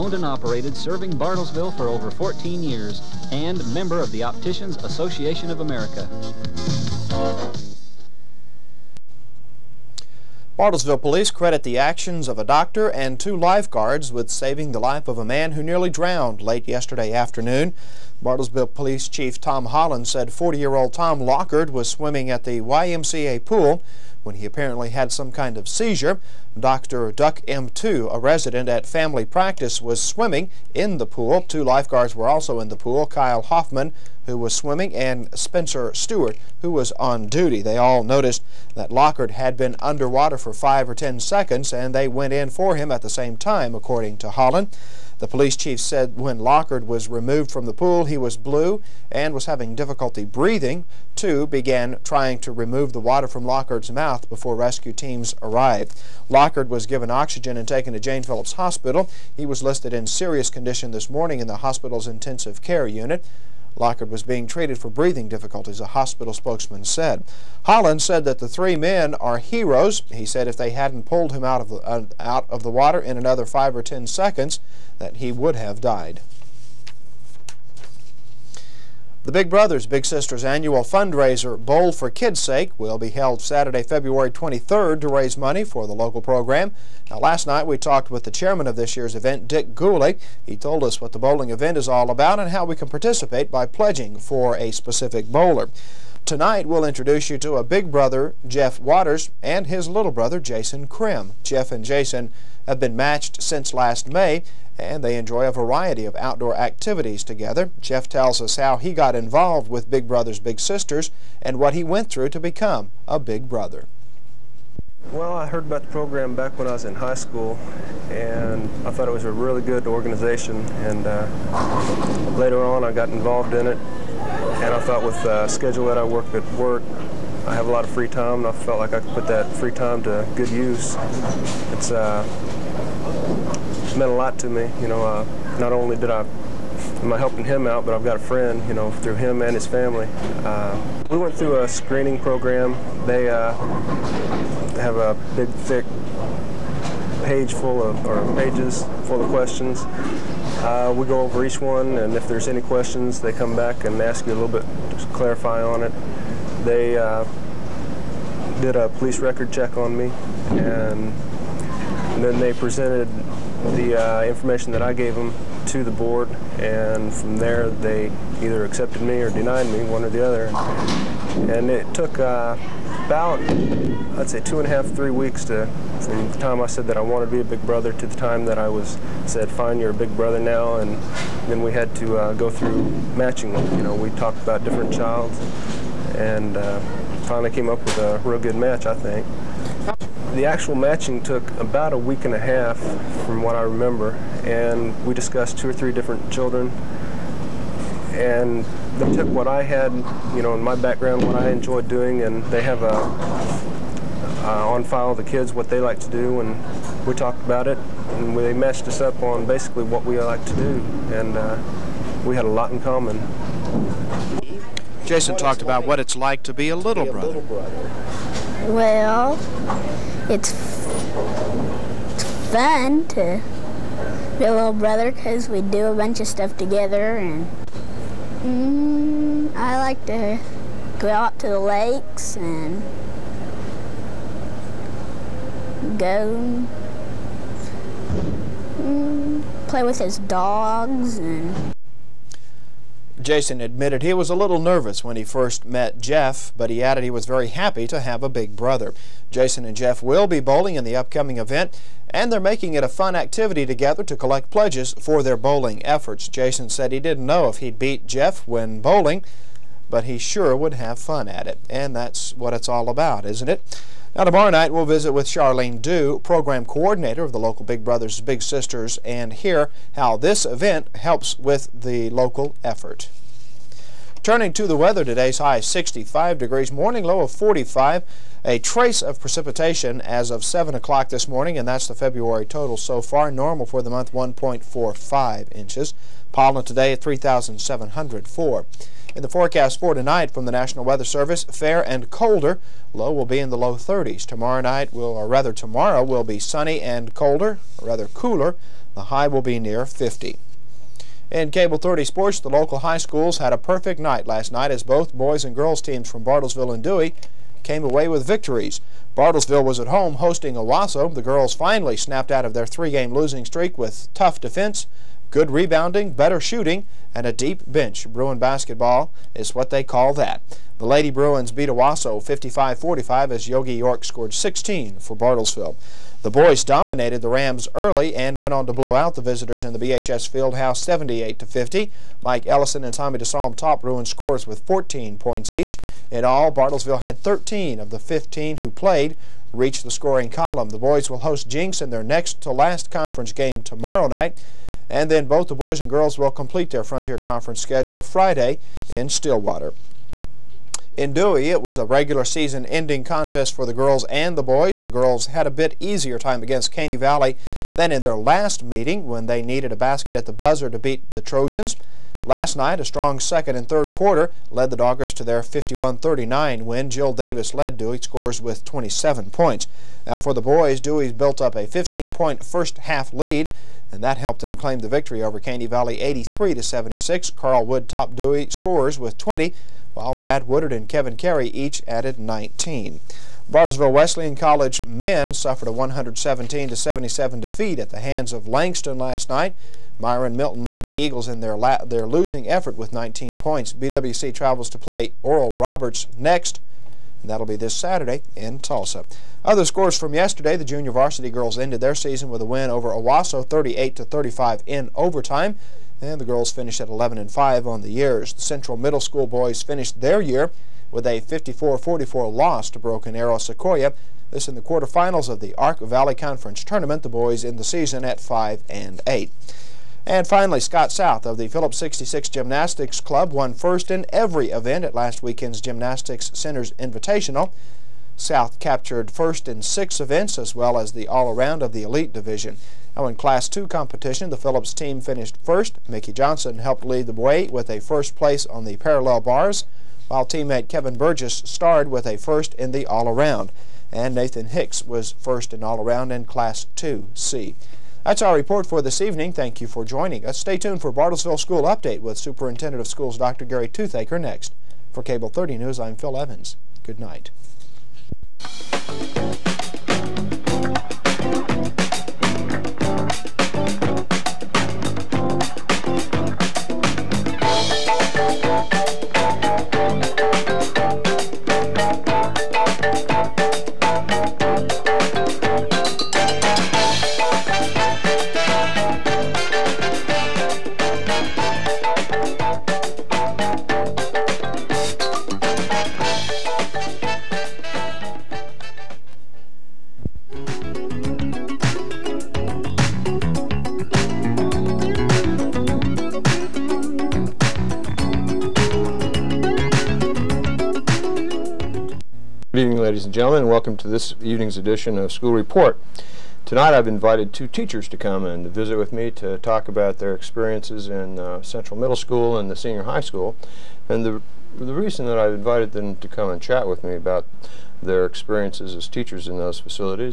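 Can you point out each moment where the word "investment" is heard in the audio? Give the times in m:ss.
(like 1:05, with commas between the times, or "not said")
not said.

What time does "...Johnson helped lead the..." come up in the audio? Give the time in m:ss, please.
7:16.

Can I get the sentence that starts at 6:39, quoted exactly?
Other scores from yesterday, the junior varsity girls ended their season with a win over Owasso 38-35 to in overtime.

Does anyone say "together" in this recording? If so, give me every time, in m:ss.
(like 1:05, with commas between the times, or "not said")
1:47, 3:46, 4:13.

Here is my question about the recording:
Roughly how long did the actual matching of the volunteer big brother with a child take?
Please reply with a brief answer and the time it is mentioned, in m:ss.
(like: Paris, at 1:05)
a week and a half, at 3:11.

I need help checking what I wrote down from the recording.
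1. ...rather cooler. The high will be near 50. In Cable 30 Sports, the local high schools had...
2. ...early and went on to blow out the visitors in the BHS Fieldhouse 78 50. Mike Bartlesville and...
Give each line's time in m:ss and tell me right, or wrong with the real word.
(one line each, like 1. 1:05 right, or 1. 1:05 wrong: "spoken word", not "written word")
1. 4:57 right
2. 5:27 wrong: "Ellison", not "Bartlesville".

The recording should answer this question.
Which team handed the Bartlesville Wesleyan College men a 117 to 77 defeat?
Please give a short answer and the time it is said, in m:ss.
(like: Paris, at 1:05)
Langston, at 6:28.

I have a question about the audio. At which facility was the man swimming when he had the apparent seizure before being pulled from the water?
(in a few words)
YMCA pool.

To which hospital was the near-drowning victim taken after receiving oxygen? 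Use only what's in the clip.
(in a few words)
Jane Phillips Hospital.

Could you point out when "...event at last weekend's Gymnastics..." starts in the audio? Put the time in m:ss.
7:04.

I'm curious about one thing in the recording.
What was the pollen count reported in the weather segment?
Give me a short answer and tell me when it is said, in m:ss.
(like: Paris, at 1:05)
3,704, at 4:47.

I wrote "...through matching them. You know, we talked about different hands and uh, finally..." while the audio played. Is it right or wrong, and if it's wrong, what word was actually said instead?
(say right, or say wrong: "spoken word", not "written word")
wrong: "childs", not "hands".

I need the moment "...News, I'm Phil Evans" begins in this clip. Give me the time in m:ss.
7:35.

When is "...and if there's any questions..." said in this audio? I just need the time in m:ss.
2:31.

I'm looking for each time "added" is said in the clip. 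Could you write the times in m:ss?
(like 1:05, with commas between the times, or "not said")
4:06, 6:21.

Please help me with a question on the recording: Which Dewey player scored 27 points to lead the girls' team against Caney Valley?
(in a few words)
Jill Davis.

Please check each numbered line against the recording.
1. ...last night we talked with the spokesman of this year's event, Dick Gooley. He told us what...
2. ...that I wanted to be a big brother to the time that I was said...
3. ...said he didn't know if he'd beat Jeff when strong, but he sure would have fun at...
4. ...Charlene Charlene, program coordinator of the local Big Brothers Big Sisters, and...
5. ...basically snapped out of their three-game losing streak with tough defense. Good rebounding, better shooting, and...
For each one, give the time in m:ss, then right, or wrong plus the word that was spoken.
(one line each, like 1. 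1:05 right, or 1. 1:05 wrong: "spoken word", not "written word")
1. 1:27 wrong: "chairman", not "spokesman"
2. 2:56 right
3. 4:16 wrong: "bowling", not "strong"
4. 4:25 wrong: "Dew", not "Charlene"
5. 5:11 wrong: "finally", not "basically".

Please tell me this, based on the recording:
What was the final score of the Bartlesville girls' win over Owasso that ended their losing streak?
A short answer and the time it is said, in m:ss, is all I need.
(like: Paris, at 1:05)
55-45, at 5:22.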